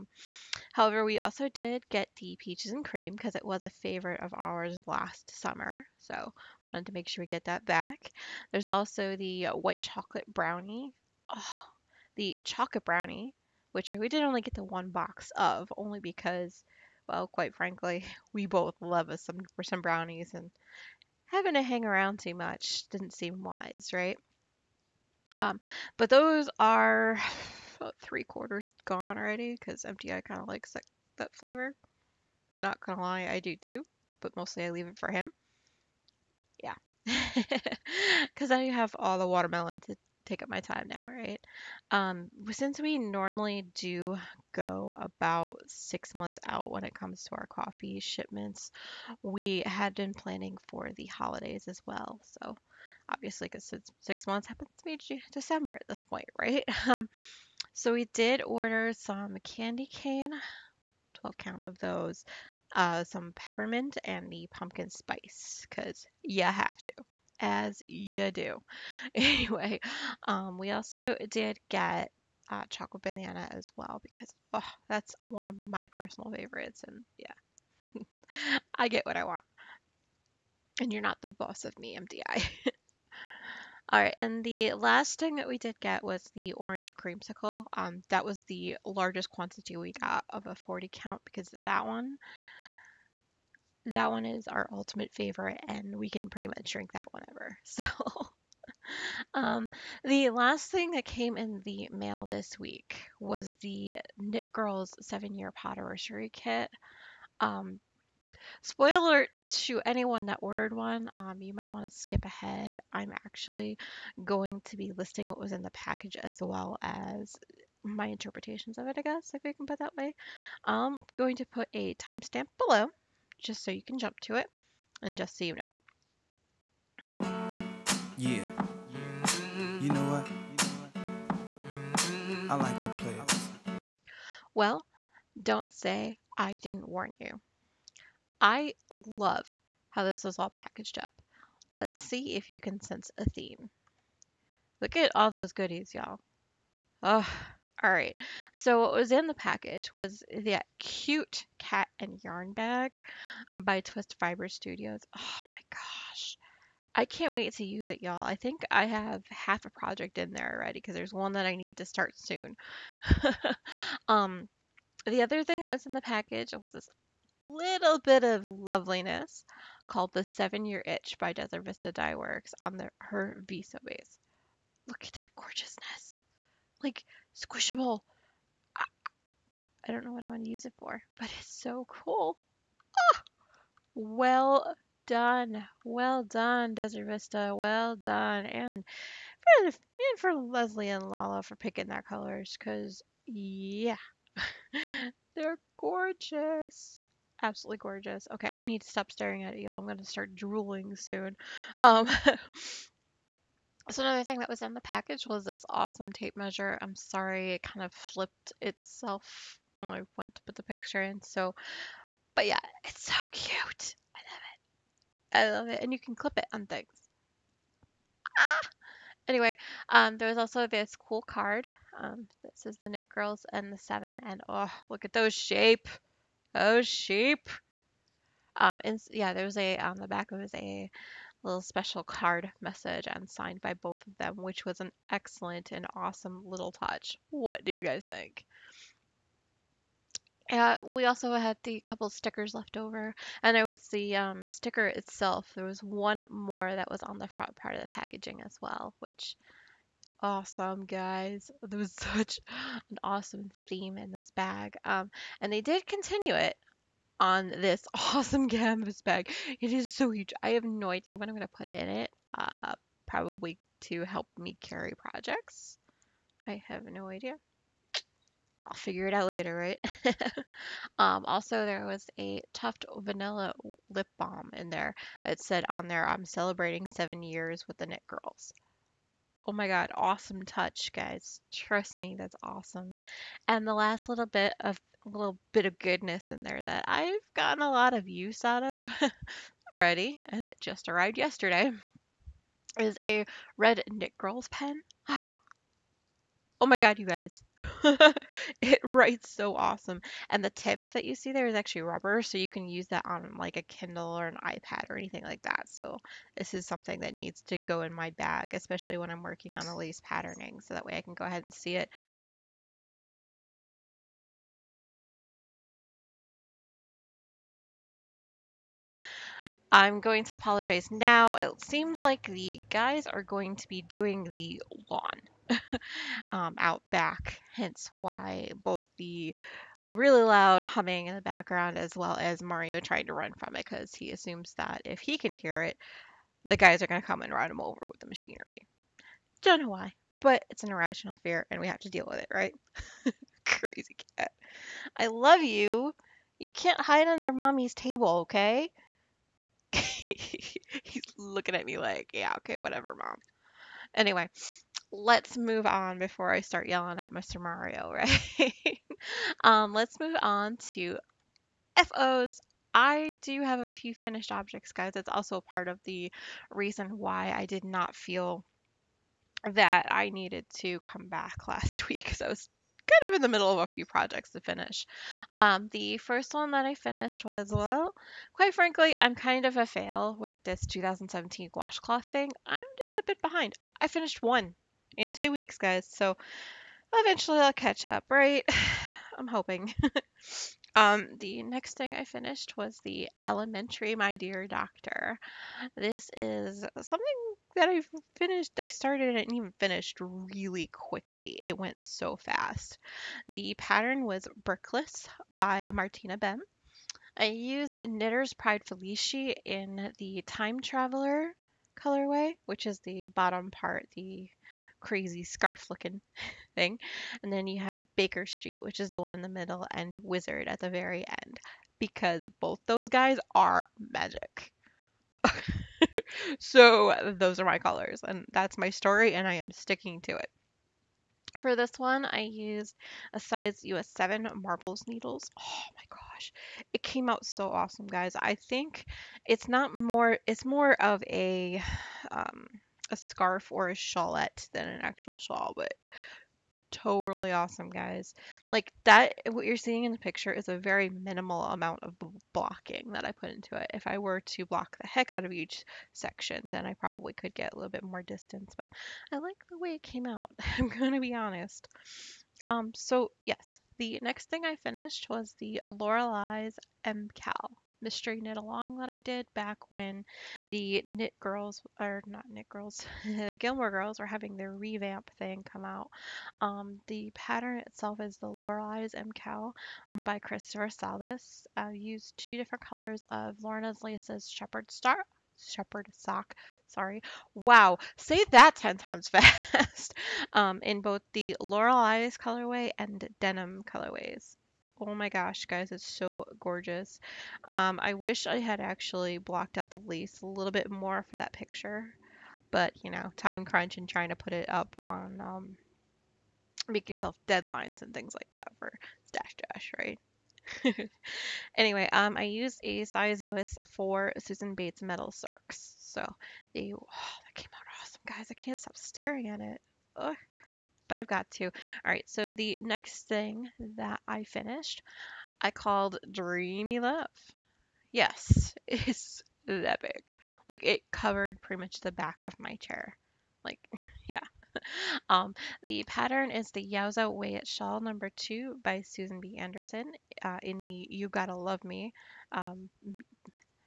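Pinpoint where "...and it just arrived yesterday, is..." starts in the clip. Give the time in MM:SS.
04:50.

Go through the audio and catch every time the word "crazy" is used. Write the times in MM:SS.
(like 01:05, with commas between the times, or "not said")
05:43, 06:54.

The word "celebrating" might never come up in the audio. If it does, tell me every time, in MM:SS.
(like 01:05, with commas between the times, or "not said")
04:36.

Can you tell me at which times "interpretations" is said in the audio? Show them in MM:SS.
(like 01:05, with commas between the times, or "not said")
01:58.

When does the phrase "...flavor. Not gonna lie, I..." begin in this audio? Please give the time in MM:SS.
00:31.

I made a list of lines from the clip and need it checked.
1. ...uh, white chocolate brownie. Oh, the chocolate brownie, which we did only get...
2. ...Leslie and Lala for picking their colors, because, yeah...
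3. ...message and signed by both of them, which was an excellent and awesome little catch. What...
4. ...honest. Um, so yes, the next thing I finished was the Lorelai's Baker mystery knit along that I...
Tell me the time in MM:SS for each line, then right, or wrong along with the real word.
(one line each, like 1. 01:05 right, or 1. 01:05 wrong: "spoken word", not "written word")
1. 00:09 right
2. 03:10 right
3. 03:52 wrong: "touch", not "catch"
4. 07:41 wrong: "MKAL", not "Baker".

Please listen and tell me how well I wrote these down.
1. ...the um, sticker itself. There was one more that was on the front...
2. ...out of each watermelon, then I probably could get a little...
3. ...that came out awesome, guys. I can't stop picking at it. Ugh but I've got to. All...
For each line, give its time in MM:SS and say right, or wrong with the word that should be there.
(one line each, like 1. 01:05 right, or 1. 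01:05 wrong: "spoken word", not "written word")
1. 04:03 right
2. 07:35 wrong: "section", not "watermelon"
3. 08:36 wrong: "staring", not "picking".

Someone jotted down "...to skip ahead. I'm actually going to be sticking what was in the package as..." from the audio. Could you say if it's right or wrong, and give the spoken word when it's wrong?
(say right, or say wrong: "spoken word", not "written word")
wrong: "listing", not "sticking".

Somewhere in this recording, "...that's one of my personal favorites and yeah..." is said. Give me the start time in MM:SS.
01:14.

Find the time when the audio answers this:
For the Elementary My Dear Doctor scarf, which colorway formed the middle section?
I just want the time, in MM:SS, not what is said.
06:57.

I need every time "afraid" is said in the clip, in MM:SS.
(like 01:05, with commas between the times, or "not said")
not said.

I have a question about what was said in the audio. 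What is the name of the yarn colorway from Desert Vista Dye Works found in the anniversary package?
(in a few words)
The Seven Year Itch.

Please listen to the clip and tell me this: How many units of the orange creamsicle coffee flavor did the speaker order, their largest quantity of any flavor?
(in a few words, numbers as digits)
40.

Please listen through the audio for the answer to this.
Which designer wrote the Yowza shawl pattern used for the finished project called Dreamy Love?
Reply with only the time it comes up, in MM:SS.
08:58.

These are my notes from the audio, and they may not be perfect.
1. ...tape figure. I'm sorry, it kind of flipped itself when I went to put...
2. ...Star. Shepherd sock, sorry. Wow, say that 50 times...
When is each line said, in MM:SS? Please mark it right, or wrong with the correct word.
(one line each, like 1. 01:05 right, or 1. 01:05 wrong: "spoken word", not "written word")
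1. 03:26 wrong: "measure", not "figure"
2. 08:04 wrong: "10", not "50".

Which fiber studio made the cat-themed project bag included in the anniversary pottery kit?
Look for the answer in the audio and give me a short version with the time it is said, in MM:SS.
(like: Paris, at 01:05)
Twist Fiber Studios, at 02:33.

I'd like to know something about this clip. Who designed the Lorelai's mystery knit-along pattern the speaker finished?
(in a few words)
Christopher Salas.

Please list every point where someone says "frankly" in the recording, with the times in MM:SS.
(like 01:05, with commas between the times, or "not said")
00:17, 06:18.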